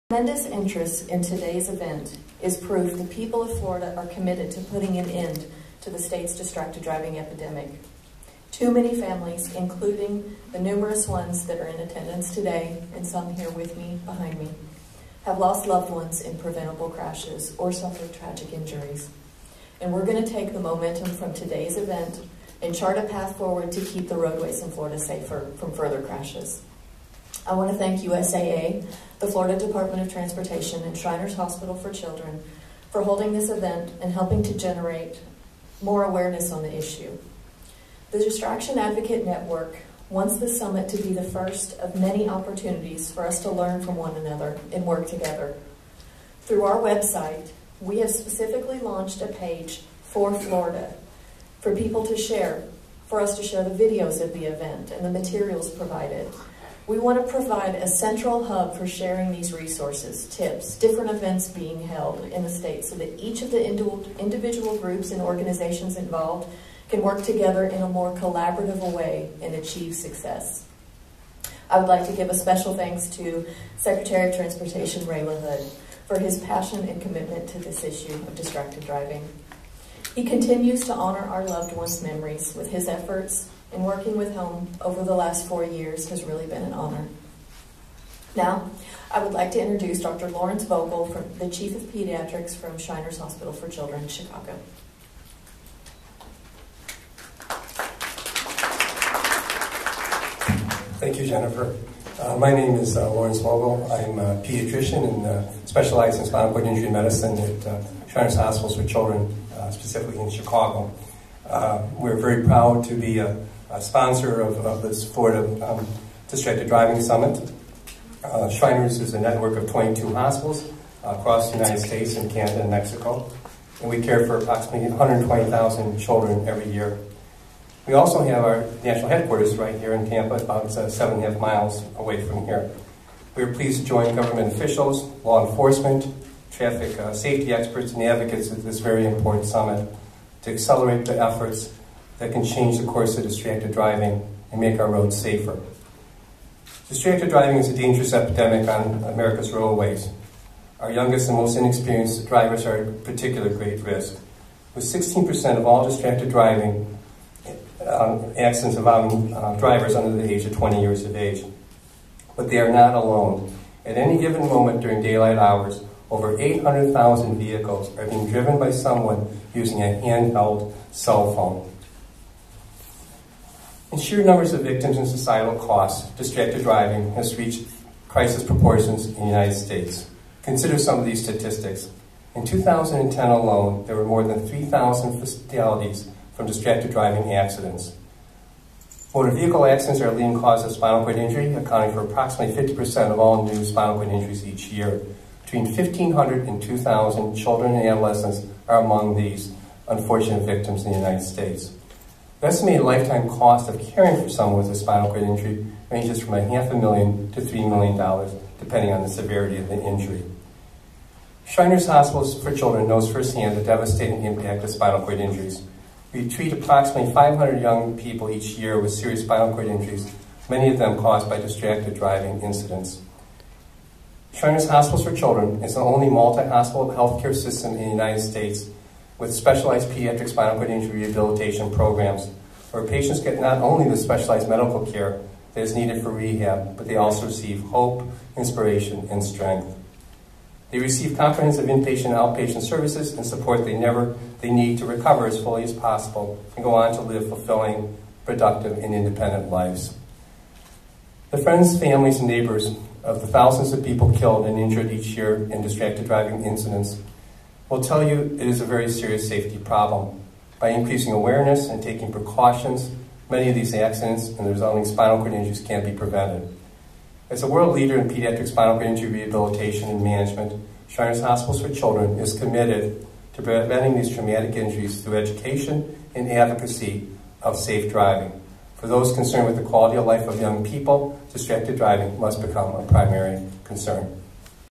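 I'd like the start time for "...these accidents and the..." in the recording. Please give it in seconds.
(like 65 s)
263 s.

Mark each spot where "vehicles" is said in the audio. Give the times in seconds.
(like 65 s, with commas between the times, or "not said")
167 s, 189 s.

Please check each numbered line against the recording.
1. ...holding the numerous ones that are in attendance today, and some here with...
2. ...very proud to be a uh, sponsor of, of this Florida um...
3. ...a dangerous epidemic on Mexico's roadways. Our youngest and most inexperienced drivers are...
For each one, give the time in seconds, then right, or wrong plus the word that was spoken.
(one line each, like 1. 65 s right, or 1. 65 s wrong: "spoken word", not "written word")
1. 9 s wrong: "including", not "holding"
2. 112 s right
3. 147 s wrong: "America", not "Mexico".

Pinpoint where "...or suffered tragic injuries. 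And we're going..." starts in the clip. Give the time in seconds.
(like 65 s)
17 s.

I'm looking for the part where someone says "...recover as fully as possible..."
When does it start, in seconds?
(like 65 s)
244 s.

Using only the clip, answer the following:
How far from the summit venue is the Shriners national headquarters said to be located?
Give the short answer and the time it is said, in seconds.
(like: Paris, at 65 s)
7.5 miles, at 130 s.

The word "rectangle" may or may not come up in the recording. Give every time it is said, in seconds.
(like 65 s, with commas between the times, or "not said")
not said.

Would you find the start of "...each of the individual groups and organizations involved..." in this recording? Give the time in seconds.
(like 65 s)
63 s.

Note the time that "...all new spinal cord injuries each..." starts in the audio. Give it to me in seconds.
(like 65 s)
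193 s.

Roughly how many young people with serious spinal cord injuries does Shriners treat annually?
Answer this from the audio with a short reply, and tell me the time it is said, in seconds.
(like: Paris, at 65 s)
500, at 217 s.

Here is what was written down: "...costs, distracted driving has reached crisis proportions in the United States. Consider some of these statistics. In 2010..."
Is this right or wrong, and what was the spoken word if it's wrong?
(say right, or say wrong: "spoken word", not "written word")
right.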